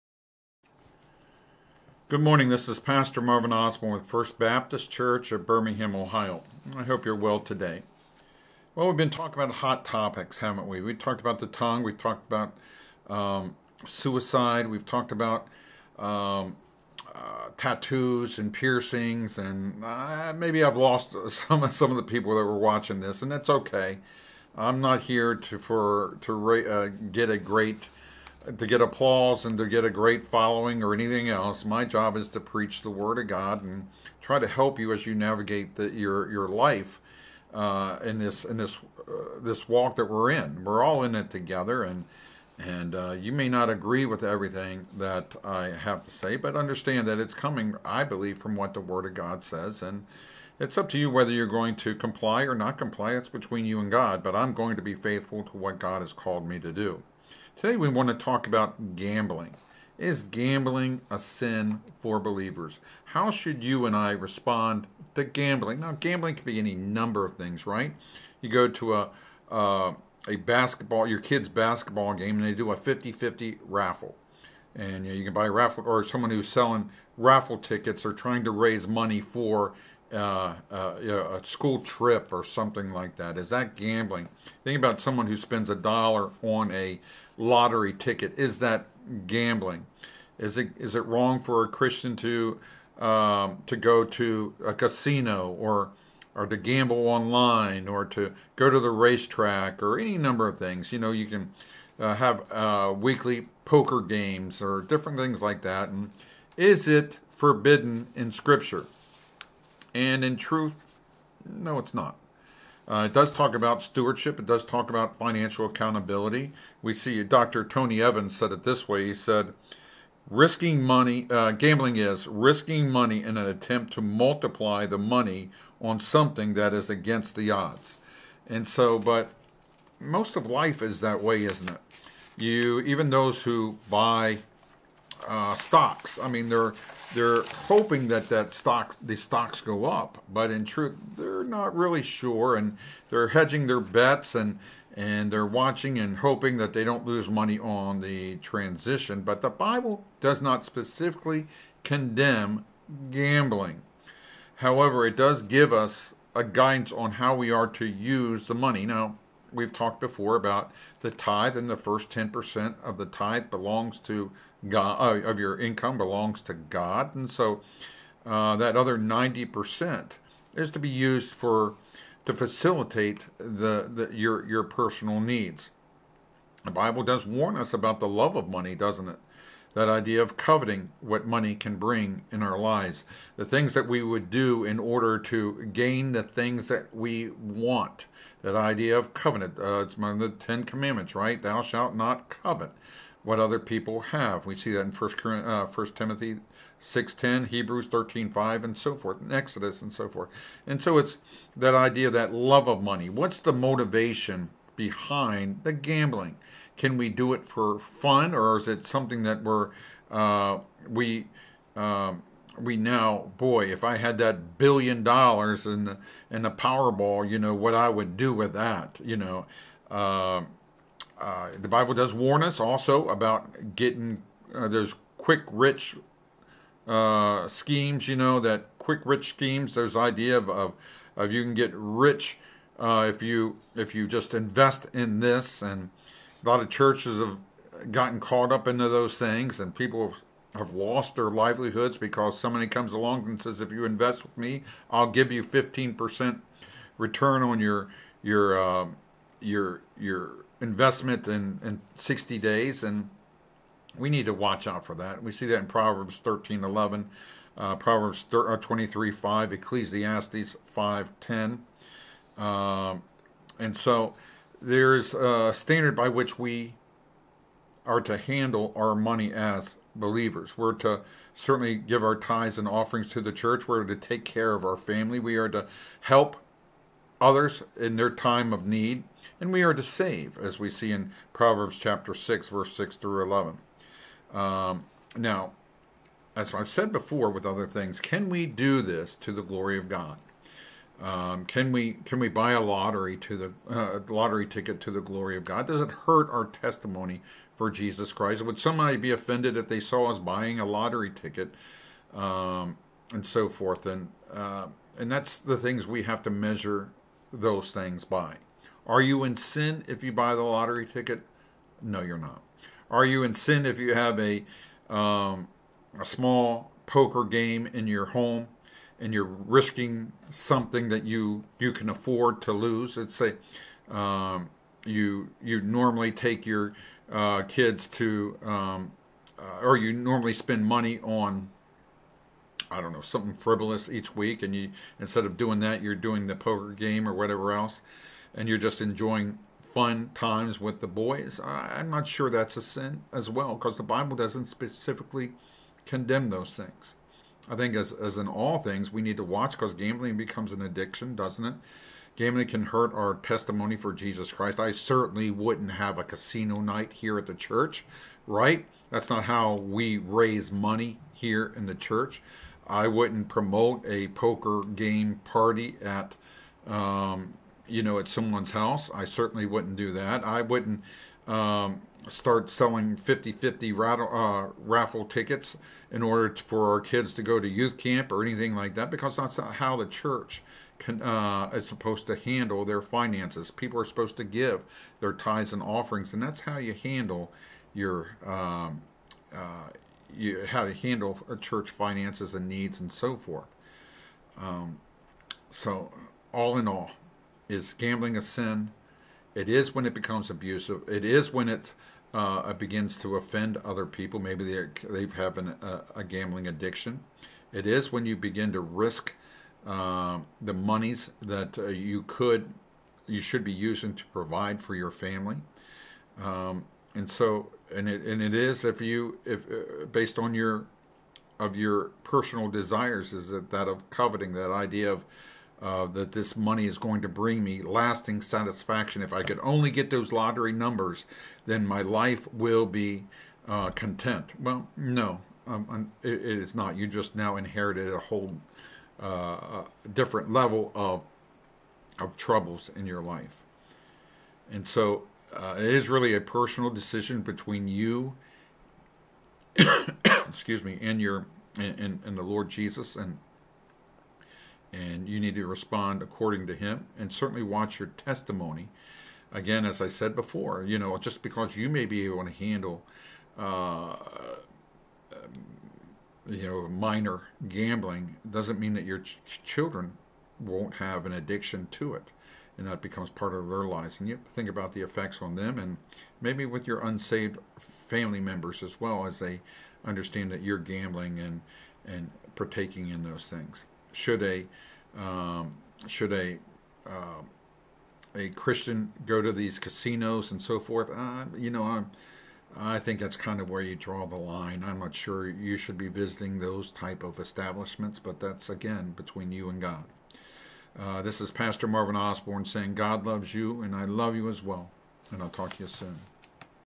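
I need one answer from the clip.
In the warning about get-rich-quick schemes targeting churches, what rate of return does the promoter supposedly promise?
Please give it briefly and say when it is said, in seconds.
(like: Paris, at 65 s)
15%, at 245 s.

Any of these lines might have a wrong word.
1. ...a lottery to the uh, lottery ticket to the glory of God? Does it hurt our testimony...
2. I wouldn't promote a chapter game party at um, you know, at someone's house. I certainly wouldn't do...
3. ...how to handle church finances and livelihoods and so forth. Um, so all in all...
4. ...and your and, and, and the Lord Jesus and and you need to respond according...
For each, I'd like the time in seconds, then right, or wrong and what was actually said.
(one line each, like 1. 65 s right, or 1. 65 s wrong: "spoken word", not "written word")
1. 292 s right
2. 362 s wrong: "poker", not "chapter"
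3. 390 s wrong: "needs", not "livelihoods"
4. 450 s right.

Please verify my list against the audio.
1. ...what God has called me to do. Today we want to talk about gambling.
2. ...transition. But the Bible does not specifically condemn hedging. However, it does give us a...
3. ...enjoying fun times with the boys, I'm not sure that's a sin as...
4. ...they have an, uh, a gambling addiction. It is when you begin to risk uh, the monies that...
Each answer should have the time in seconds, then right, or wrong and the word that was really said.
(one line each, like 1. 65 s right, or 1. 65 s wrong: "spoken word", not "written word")
1. 55 s right
2. 148 s wrong: "gambling", not "hedging"
3. 338 s right
4. 404 s right.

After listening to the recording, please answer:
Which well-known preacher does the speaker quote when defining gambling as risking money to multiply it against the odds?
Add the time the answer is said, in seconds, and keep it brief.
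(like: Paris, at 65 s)
Dr. Tony Evans, at 117 s.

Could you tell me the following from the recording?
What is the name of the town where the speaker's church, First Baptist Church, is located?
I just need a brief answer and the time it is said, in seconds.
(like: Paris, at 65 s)
Birmingham, Ohio, at 5 s.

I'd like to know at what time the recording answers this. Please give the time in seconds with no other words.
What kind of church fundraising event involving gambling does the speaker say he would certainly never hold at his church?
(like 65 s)
356 s.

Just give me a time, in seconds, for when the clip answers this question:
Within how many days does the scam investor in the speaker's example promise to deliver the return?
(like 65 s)
251 s.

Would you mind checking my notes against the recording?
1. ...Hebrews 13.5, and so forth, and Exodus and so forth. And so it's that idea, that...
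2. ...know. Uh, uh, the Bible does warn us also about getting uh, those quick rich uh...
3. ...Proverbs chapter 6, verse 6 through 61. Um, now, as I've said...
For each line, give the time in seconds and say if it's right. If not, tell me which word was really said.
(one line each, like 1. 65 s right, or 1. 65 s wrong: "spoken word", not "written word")
1. 197 s right
2. 219 s right
3. 281 s wrong: "11", not "61".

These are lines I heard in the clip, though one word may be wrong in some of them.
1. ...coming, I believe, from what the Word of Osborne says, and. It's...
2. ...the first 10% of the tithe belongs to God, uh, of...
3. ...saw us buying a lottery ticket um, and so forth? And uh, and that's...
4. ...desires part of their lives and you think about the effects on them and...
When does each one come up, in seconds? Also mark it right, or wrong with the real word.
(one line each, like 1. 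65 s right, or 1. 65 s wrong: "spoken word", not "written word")
1. 47 s wrong: "God", not "Osborne"
2. 161 s right
3. 299 s right
4. 472 s wrong: "becomes", not "desires".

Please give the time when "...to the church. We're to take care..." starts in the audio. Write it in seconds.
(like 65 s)
273 s.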